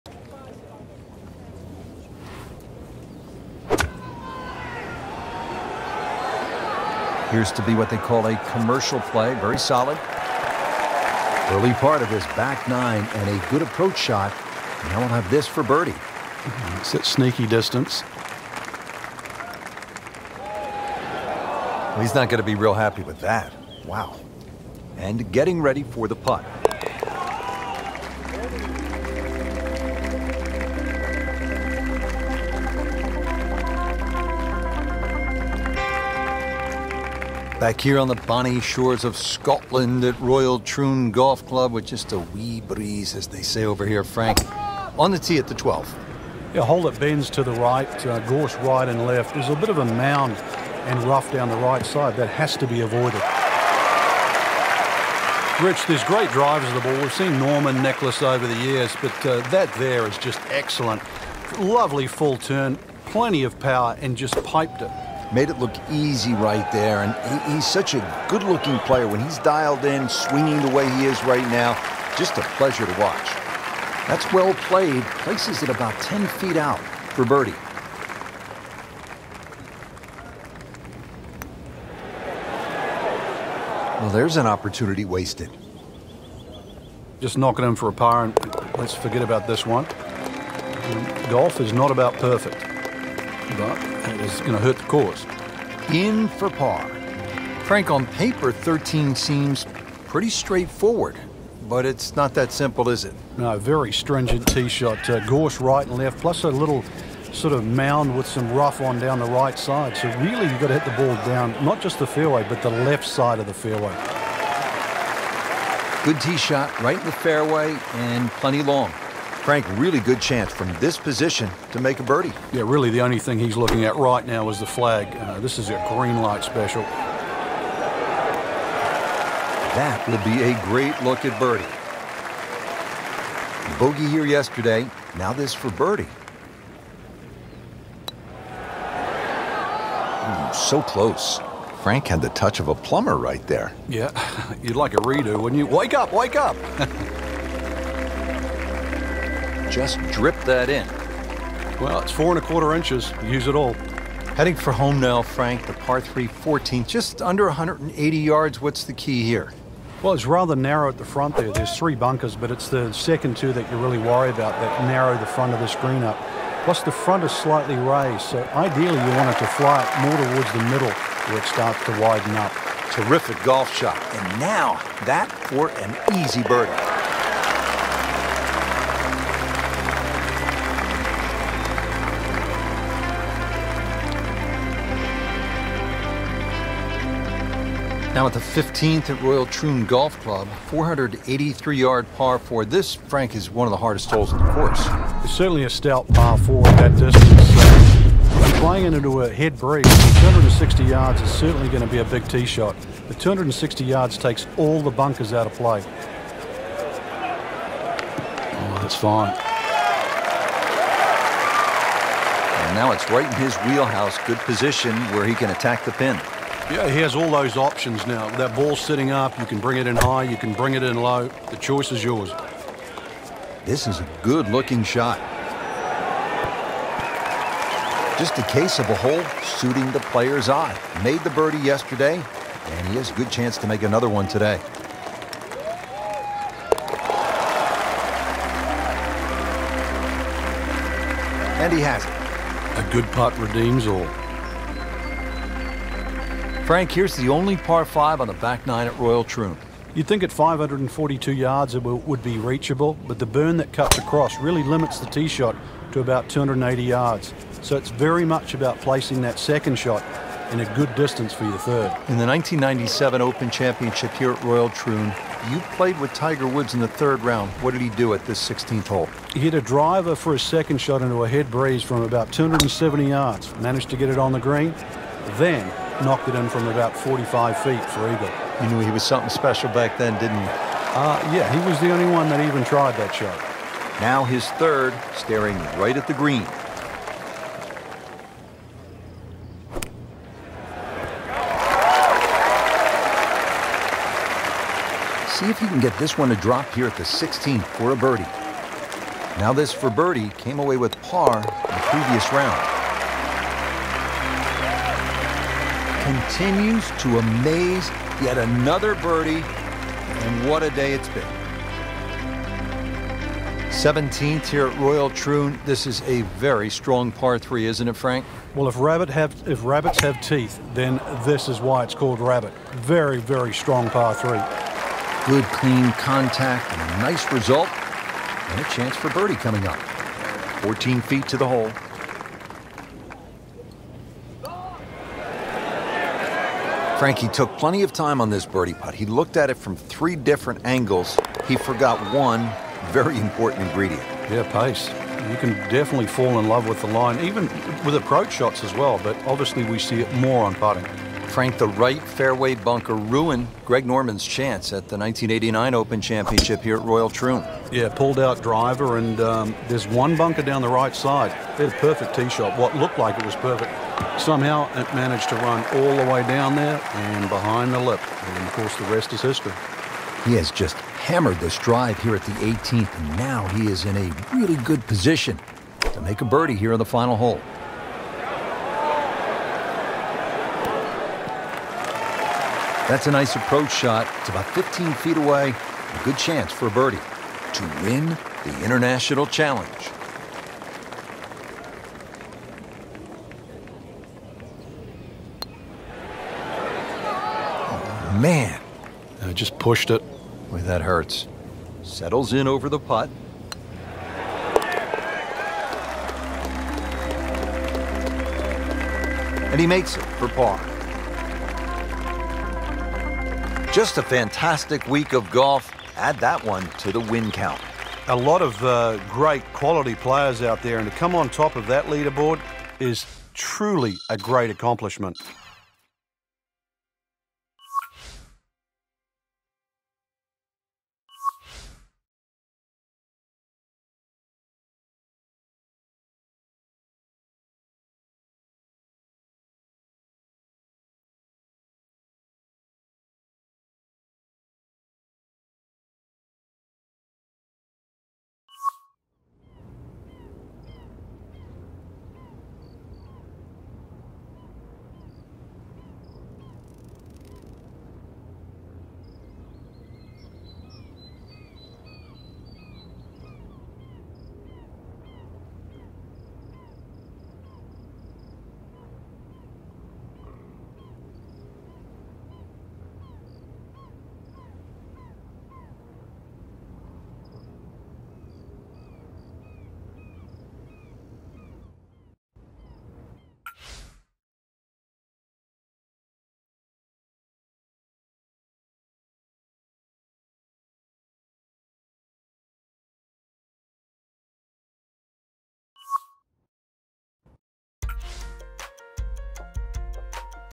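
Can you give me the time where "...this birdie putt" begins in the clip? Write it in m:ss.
5:38.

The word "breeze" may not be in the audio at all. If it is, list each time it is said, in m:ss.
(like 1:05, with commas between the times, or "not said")
0:42, 3:19, 4:31.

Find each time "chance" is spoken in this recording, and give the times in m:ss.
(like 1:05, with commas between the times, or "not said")
2:00, 3:53, 5:28, 5:54, 6:26.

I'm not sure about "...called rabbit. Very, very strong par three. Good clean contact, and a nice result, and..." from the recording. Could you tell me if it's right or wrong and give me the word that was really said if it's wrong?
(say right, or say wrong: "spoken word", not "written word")
right.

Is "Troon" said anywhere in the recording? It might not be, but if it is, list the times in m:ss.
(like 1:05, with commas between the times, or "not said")
0:40, 3:09, 4:09, 4:24, 5:15, 5:57.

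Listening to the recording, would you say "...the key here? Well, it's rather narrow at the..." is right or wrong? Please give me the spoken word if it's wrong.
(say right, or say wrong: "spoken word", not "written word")
right.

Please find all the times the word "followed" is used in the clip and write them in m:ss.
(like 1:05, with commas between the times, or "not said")
not said.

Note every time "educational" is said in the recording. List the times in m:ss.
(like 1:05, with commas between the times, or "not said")
not said.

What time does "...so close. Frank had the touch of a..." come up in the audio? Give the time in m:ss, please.
2:20.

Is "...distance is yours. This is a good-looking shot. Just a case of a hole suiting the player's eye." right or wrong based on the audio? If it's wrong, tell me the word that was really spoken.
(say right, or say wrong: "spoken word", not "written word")
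wrong: "choice", not "distance".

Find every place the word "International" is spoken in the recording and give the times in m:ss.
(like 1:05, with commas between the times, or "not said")
6:28.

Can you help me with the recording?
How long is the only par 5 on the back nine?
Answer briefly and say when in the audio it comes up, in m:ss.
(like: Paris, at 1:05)
542 yards, at 4:10.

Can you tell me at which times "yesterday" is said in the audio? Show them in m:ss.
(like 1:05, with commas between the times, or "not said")
2:14, 3:51.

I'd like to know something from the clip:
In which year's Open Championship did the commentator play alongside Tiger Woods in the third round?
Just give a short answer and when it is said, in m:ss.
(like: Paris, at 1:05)
1997, at 4:22.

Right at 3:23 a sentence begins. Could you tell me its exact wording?
The 260 yards takes all the bunkers out of play.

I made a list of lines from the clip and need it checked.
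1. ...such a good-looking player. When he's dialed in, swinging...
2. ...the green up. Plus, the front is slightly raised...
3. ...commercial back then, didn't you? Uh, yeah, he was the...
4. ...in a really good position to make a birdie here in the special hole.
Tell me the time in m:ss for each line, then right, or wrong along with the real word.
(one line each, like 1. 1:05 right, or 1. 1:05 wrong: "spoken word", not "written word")
1. 1:07 right
2. 2:45 right
3. 4:39 wrong: "special", not "commercial"
4. 6:13 wrong: "final", not "special".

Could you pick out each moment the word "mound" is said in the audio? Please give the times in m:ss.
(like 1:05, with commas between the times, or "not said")
0:49, 1:47.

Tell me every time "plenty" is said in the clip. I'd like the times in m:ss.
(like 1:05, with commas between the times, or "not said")
1:03, 1:58, 5:37.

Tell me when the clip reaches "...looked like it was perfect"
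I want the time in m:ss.
6:02.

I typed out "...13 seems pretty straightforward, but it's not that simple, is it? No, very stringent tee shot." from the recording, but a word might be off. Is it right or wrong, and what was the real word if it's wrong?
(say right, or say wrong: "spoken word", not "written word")
right.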